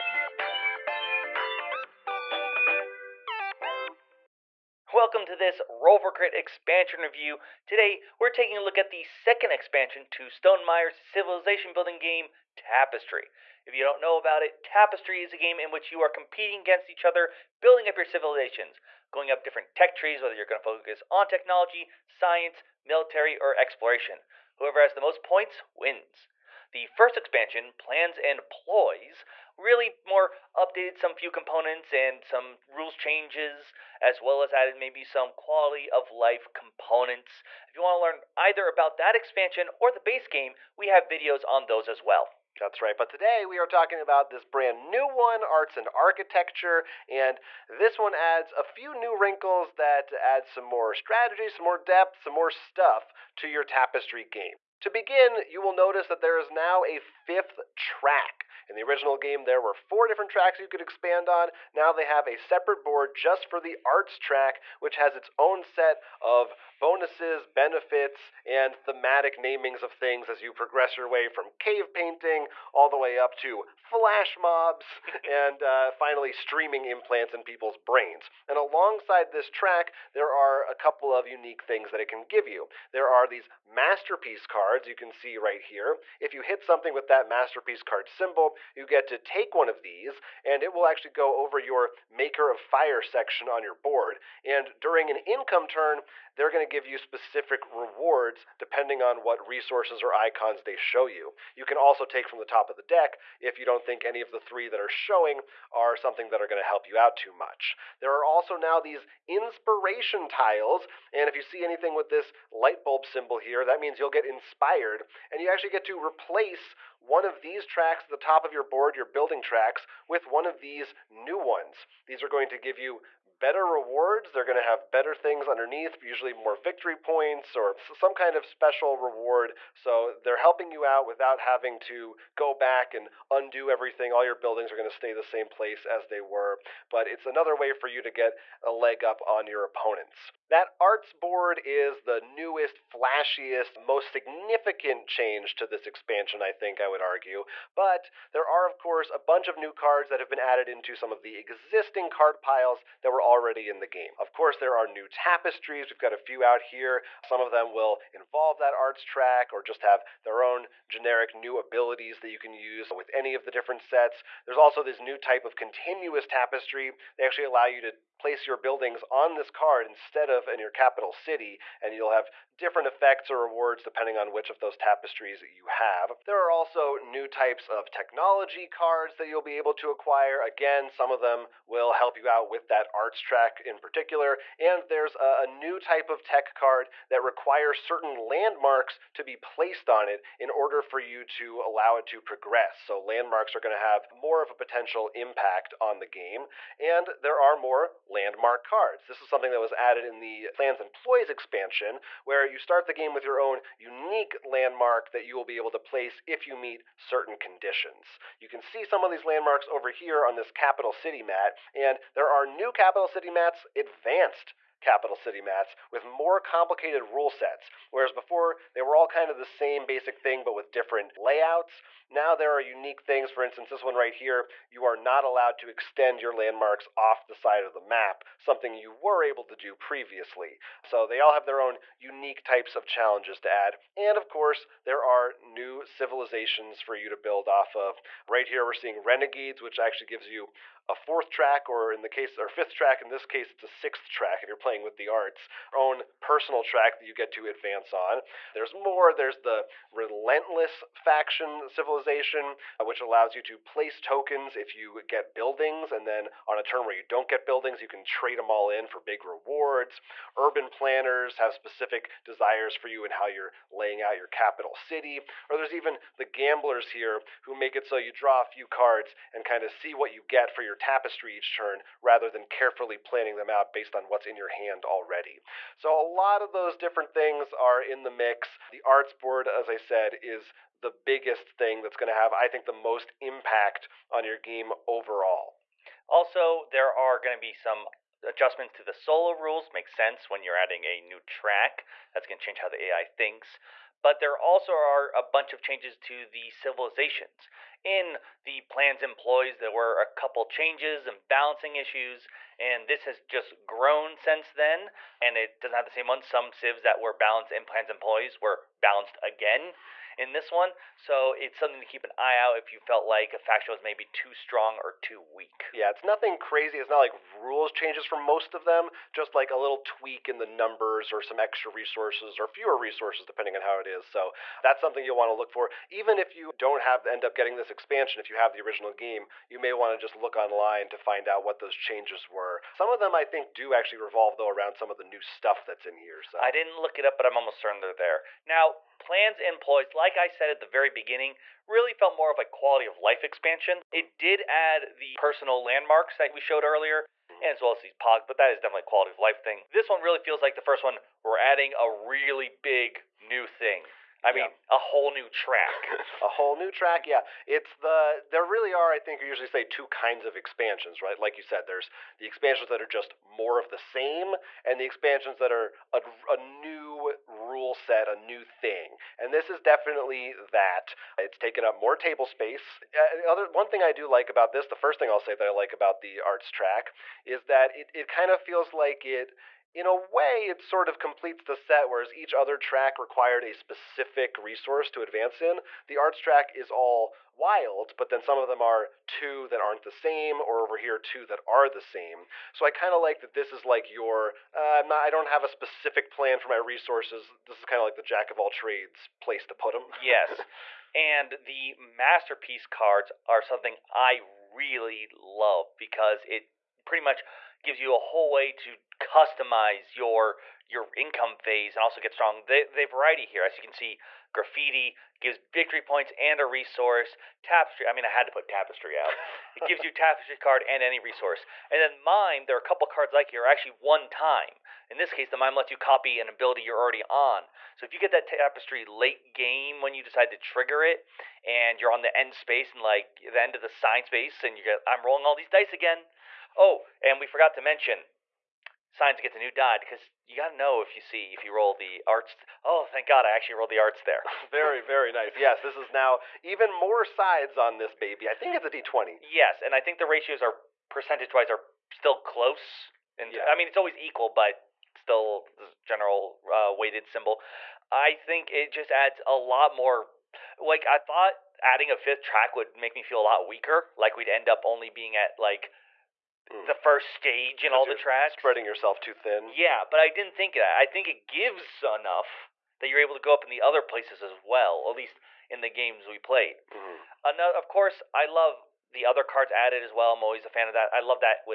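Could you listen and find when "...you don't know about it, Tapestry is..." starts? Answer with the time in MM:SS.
00:13.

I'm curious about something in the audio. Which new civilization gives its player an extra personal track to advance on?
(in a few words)
renegades.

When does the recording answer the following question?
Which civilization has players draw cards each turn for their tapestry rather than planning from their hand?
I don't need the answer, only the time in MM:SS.
04:26.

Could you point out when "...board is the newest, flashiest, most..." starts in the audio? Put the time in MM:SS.
02:21.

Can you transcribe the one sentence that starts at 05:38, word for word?
Now, plans and ploys, like I said at the very beginning, really felt more of a quality of life expansion.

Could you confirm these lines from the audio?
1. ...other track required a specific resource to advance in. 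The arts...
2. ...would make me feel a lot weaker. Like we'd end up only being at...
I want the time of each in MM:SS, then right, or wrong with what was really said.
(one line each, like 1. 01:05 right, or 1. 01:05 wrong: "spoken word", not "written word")
1. 06:22 right
2. 07:42 right.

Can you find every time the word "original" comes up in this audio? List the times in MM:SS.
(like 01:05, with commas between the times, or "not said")
00:58, 05:28.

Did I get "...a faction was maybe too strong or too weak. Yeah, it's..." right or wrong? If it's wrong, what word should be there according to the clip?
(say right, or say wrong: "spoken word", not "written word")
right.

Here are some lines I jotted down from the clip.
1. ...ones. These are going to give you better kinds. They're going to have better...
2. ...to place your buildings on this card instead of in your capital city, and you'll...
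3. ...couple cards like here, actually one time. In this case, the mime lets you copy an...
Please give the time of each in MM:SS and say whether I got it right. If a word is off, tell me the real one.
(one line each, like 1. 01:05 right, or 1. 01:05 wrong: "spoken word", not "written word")
1. 02:01 wrong: "rewards", not "kinds"
2. 02:47 right
3. 07:02 right.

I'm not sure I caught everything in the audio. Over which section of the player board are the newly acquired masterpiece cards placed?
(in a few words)
maker of fire.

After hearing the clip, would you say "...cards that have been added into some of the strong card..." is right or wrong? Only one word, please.
wrong.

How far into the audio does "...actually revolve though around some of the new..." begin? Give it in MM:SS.
05:33.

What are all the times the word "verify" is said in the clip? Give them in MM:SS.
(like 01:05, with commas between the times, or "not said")
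not said.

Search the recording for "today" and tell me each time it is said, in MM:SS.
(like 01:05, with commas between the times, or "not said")
00:07, 00:43.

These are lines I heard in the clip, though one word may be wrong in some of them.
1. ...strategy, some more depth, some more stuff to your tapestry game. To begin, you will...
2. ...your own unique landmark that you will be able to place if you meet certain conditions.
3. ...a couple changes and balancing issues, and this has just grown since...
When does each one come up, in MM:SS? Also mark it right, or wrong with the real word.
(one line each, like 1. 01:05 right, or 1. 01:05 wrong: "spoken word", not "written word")
1. 00:50 right
2. 03:23 right
3. 04:59 right.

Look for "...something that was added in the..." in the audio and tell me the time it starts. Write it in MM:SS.
03:19.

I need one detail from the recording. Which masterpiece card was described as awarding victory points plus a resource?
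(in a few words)
Graffiti.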